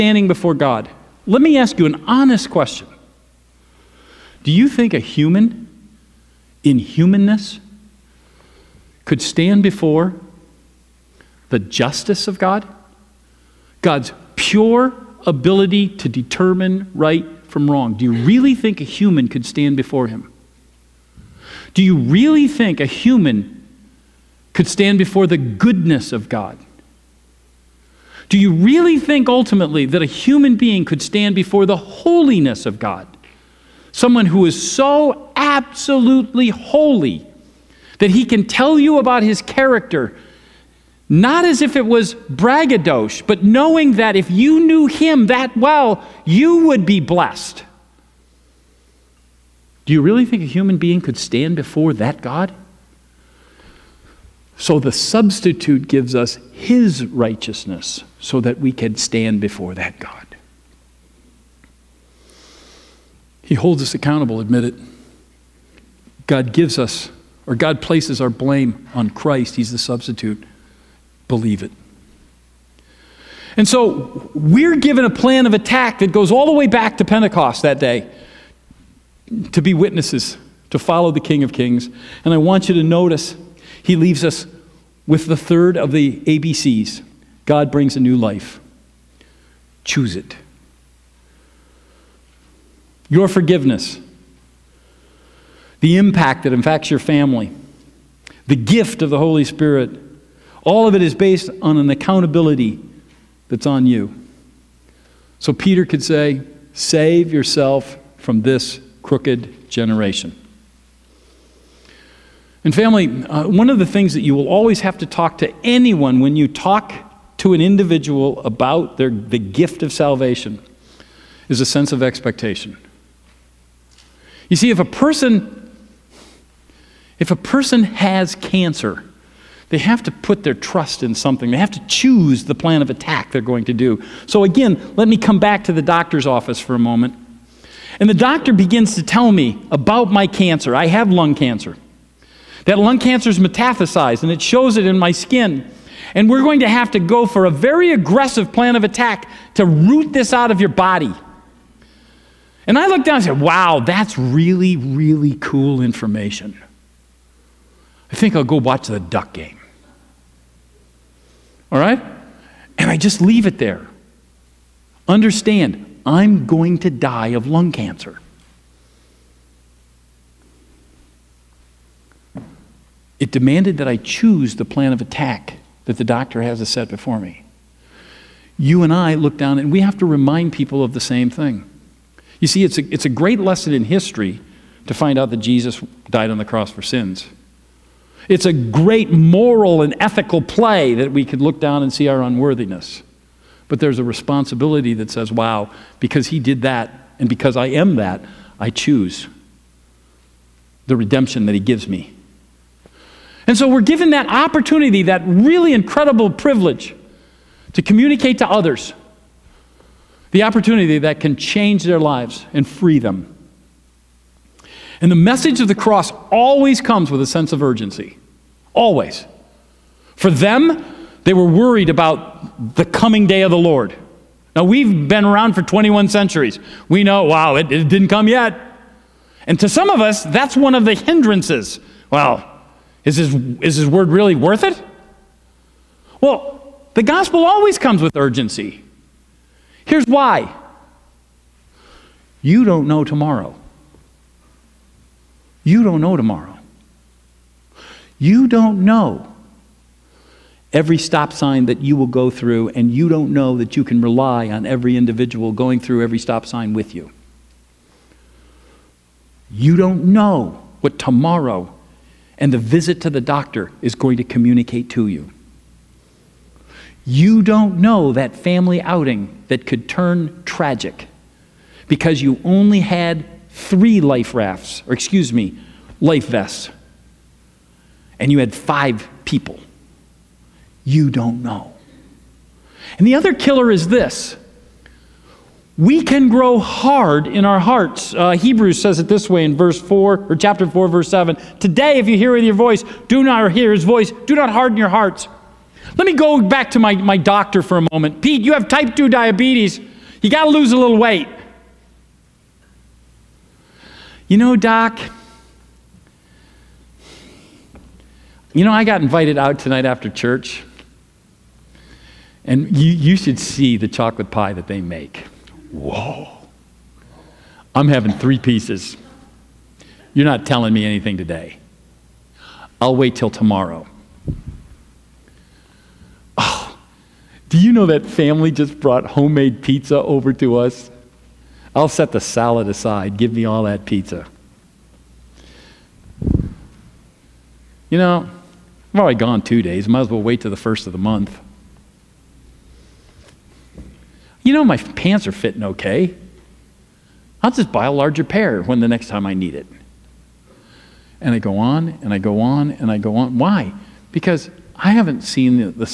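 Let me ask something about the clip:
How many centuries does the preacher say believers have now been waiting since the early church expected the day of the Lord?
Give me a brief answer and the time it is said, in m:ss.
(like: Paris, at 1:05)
21, at 3:45.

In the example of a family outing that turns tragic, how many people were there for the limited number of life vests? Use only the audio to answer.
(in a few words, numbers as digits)
5.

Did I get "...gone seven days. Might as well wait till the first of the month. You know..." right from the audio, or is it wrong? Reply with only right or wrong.
wrong.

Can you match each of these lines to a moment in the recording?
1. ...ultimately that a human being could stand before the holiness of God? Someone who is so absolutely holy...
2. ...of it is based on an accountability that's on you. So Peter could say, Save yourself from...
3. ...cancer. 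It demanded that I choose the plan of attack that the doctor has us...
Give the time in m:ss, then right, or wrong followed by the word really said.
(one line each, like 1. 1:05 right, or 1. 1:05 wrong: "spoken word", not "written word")
1. 0:29 right
2. 1:40 right
3. 2:47 right.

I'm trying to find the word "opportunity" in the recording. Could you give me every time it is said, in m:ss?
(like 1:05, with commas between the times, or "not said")
3:24, 3:30.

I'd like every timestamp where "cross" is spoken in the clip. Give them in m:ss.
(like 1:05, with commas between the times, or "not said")
3:06, 3:35.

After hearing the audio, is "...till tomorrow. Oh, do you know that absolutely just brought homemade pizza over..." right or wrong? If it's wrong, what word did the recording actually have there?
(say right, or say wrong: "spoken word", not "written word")
wrong: "family", not "absolutely".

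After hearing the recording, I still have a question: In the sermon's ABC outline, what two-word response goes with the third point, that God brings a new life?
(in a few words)
Choose it.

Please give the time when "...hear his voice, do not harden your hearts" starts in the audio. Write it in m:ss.
4:53.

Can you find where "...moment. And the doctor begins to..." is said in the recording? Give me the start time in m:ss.
2:16.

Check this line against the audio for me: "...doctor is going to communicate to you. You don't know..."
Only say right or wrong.
right.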